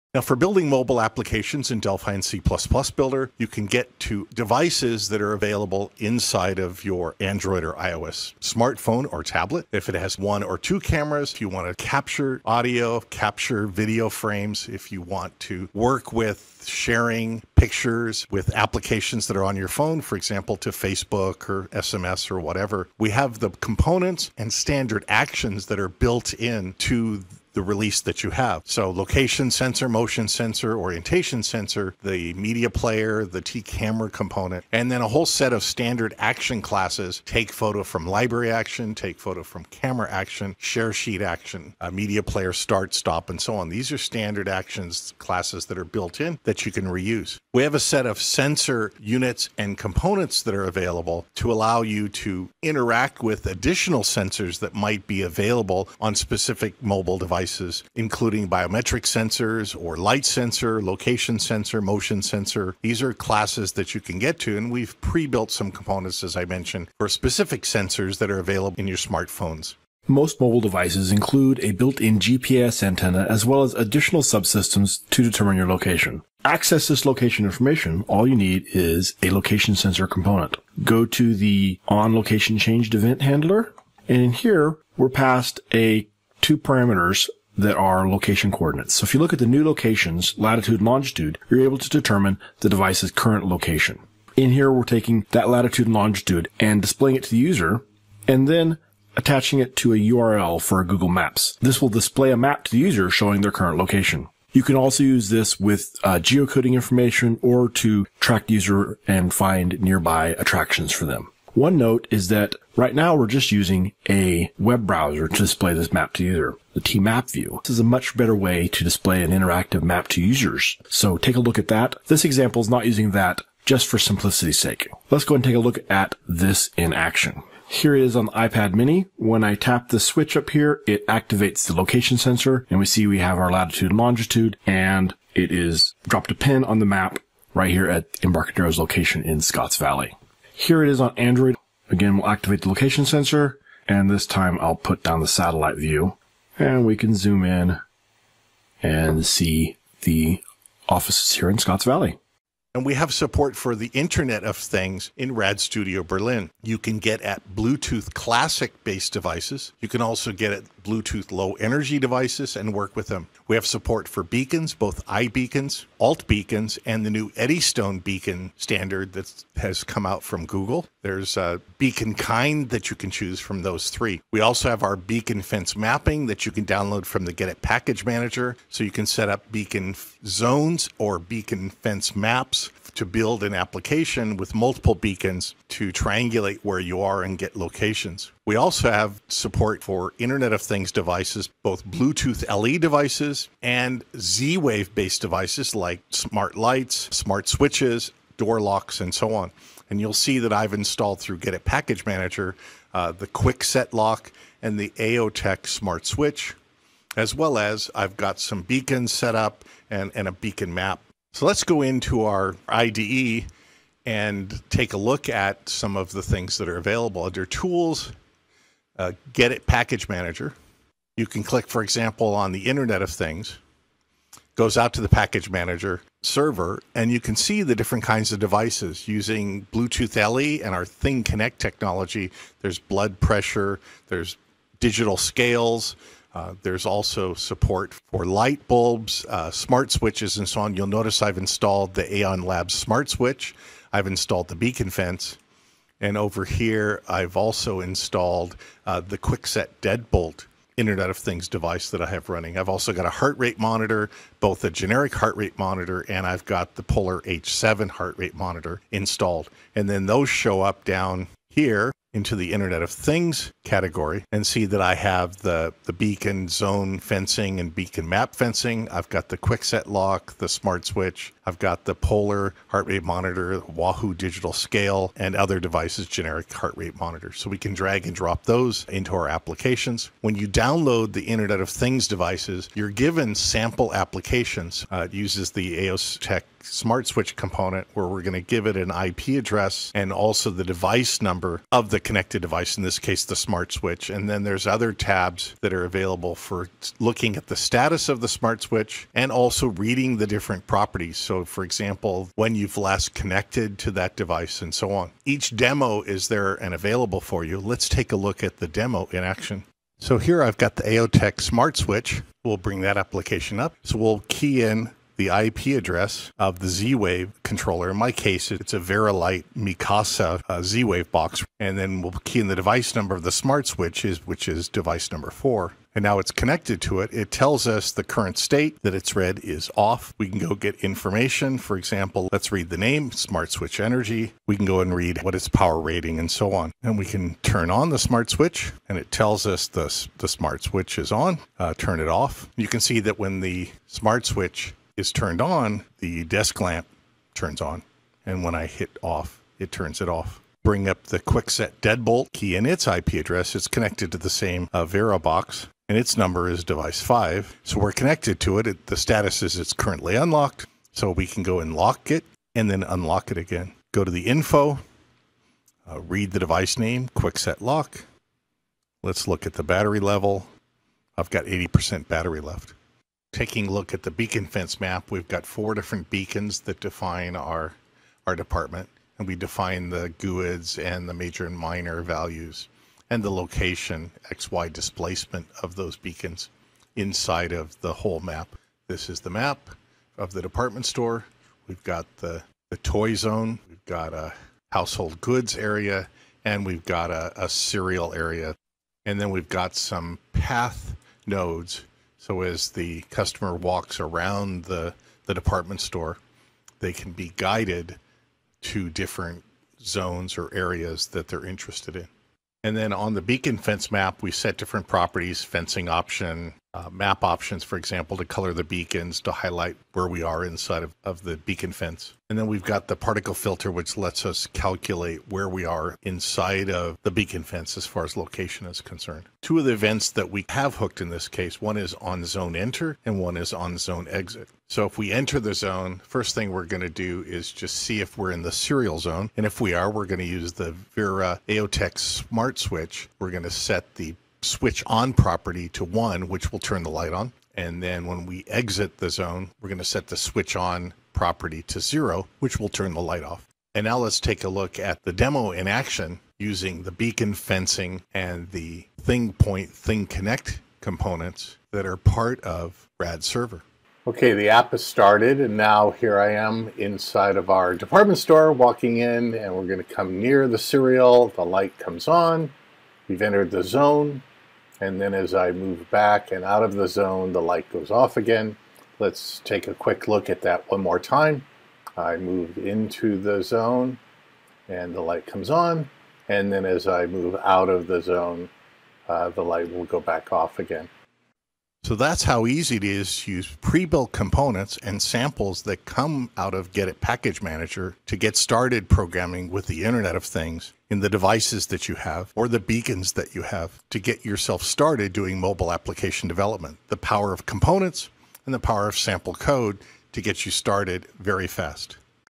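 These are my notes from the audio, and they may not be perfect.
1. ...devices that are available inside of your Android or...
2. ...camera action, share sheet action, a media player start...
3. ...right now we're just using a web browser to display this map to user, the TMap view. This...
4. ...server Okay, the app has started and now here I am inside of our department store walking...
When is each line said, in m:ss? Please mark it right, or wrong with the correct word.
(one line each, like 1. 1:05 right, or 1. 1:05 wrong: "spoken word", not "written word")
1. 0:04 right
2. 0:39 right
3. 1:52 right
4. 7:43 right.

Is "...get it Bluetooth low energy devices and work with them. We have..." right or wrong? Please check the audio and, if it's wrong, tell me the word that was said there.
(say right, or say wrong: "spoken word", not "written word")
right.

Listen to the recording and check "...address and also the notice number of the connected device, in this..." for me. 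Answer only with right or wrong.
wrong.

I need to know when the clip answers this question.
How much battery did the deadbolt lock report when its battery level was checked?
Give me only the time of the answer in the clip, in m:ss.
6:11.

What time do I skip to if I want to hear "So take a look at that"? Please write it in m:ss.
2:00.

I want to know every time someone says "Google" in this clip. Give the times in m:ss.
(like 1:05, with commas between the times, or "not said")
1:40, 2:50.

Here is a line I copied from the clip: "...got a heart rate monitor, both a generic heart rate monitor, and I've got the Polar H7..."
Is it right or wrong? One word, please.
right.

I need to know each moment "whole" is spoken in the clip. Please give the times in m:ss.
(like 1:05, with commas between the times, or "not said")
0:35, 6:27.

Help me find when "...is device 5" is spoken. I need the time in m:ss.
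5:56.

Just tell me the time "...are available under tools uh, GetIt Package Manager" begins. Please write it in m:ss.
3:36.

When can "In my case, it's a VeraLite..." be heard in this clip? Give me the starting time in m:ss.
5:17.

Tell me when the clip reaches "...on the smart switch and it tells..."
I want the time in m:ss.
5:37.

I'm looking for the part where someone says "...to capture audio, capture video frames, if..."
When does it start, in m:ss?
0:11.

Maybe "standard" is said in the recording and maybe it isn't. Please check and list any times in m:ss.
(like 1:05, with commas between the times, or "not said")
0:24, 0:35, 0:43, 2:48.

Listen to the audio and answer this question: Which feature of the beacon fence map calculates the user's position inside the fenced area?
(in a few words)
particle filter.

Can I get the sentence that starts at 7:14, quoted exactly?
So if we enter the zone, first thing we're going to do is just see if we're in the cereal zone.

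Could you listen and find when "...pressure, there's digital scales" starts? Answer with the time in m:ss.
3:53.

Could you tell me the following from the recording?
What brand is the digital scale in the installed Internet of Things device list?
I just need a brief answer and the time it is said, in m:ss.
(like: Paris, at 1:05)
Wahoo, at 4:33.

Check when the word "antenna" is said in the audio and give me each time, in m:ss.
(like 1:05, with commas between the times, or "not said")
1:12.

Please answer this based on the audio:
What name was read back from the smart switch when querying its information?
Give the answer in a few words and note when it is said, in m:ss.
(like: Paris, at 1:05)
Smart Switch Energy, at 5:33.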